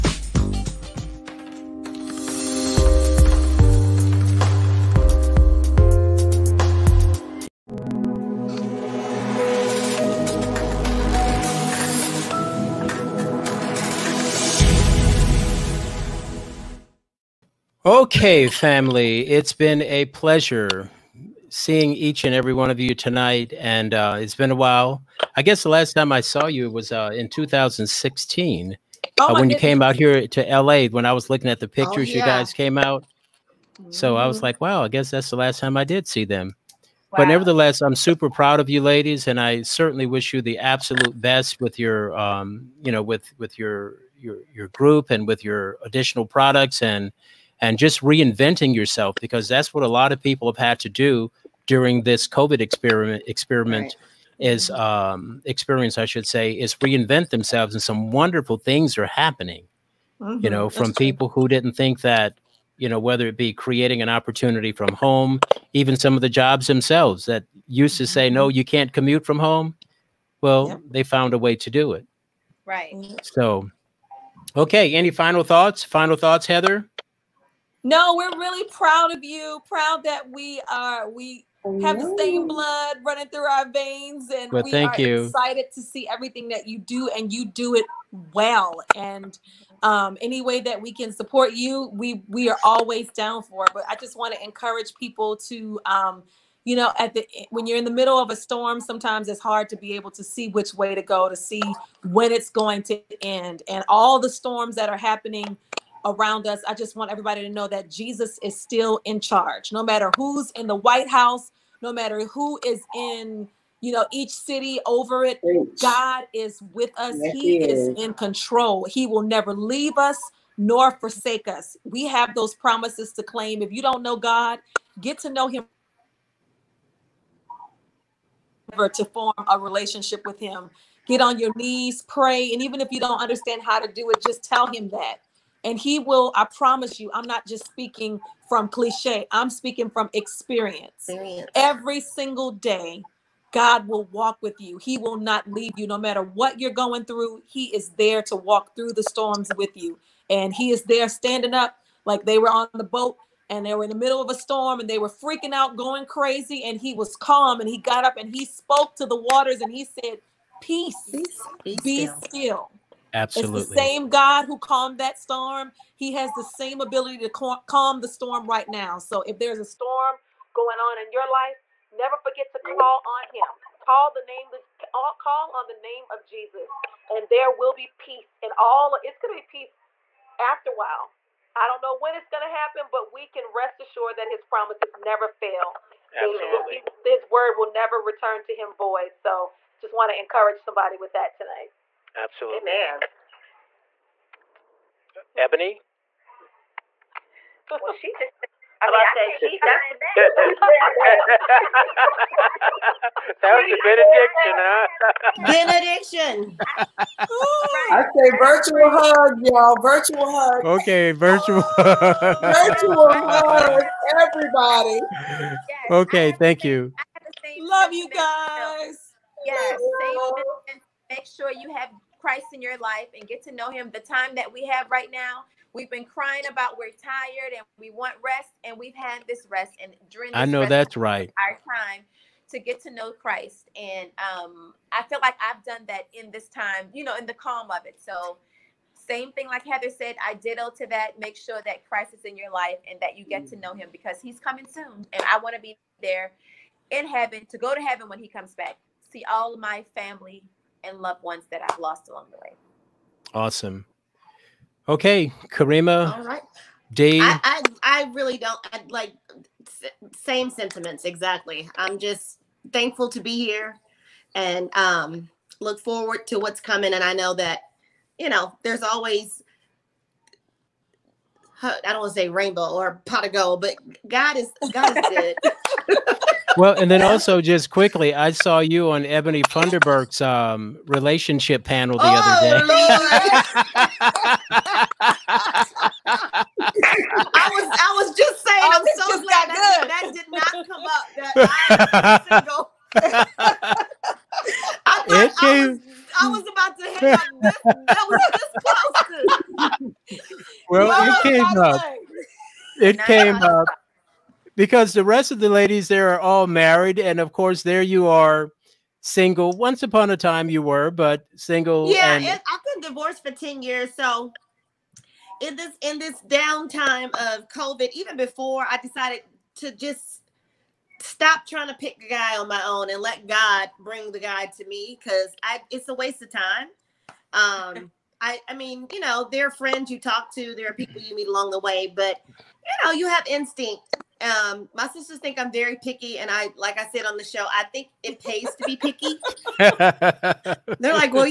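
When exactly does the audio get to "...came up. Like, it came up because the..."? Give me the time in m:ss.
5:01.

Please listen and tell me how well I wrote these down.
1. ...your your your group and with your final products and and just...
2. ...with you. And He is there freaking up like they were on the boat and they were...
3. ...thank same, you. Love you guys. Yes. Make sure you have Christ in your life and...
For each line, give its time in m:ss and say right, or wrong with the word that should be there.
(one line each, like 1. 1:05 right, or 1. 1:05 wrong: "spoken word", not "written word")
1. 0:43 wrong: "additional", not "final"
2. 2:29 wrong: "standing", not "freaking"
3. 3:36 right.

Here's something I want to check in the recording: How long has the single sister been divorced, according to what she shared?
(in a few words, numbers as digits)
10 years.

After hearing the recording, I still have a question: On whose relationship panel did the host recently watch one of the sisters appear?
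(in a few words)
Ebony Funderburk.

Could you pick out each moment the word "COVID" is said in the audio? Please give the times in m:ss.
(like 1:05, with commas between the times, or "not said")
0:52, 5:17.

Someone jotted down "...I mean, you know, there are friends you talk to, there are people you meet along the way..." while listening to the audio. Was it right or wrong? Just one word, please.
right.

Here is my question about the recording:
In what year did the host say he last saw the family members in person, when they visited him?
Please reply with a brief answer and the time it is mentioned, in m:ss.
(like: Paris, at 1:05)
2016, at 0:27.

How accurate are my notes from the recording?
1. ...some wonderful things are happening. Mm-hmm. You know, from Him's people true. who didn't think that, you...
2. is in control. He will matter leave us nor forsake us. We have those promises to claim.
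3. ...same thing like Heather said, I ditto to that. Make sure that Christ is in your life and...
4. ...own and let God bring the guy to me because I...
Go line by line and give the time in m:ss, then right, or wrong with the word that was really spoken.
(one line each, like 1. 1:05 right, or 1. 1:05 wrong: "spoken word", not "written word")
1. 0:57 wrong: "That", not "Him"
2. 1:57 wrong: "never", not "matter"
3. 3:58 right
4. 5:22 right.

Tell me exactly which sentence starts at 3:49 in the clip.
And during I know that's right.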